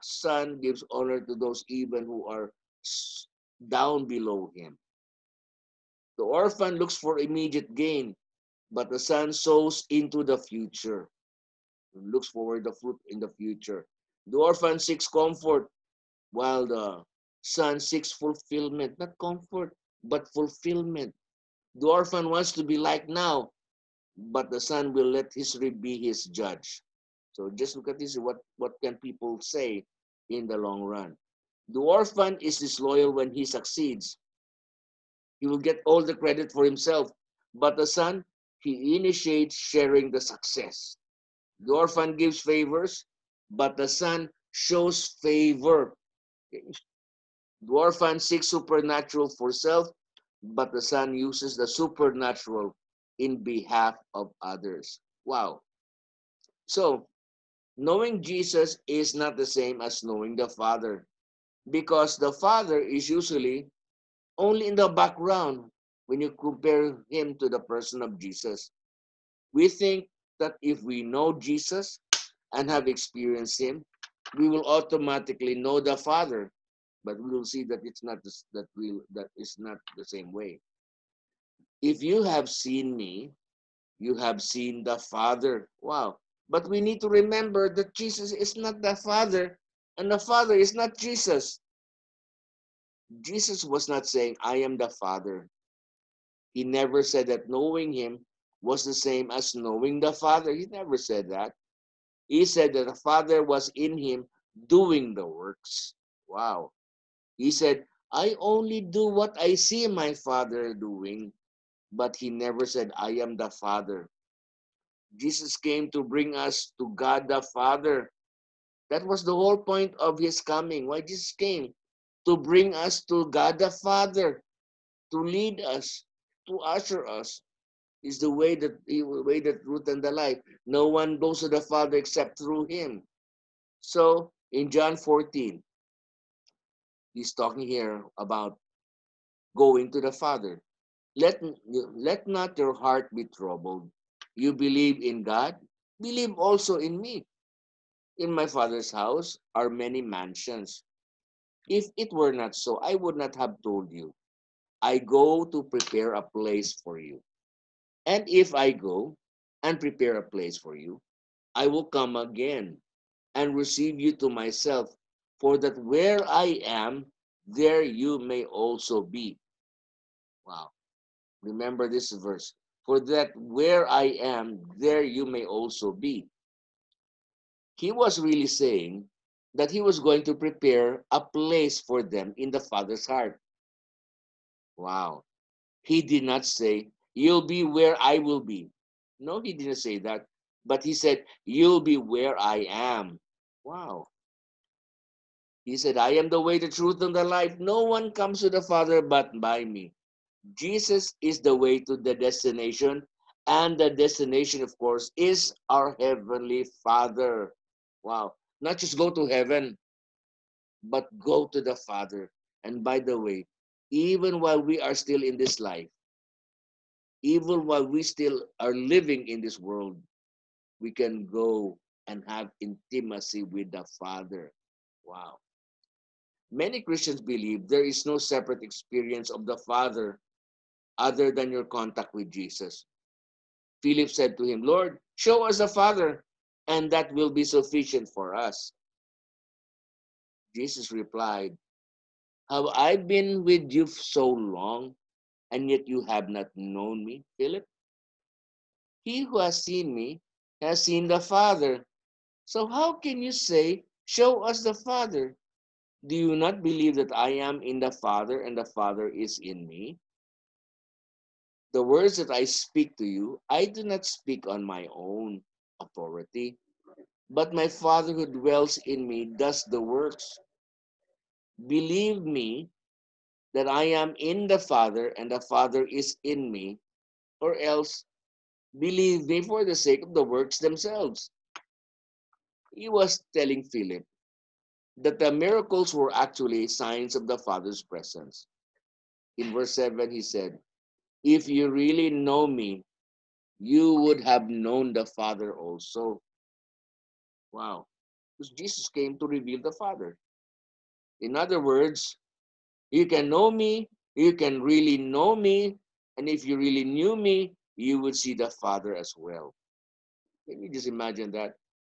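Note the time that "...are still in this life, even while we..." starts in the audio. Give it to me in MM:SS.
03:34.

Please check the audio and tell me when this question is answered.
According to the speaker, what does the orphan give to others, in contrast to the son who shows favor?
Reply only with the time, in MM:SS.
00:41.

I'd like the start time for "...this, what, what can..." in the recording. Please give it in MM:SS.
00:27.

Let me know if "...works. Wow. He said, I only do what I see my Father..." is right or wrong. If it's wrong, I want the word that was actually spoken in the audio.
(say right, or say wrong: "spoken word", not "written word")
right.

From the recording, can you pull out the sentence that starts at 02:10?
No one goes to the Father except through him.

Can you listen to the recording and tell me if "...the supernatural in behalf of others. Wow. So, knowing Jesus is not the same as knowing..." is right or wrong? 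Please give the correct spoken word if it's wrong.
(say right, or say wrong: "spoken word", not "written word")
right.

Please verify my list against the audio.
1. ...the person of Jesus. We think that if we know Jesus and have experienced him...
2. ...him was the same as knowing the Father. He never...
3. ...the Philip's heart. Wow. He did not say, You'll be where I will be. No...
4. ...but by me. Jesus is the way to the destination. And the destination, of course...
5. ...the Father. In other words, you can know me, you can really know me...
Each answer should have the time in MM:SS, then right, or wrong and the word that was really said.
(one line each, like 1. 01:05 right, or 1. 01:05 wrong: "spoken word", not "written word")
1. 01:07 right
2. 01:37 right
3. 03:02 wrong: "Father", not "Philip"
4. 03:19 right
5. 04:59 right.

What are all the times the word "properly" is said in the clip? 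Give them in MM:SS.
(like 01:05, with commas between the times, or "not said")
not said.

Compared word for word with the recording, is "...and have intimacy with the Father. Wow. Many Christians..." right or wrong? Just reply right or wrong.
right.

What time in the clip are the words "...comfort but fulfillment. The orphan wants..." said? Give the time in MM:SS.
00:19.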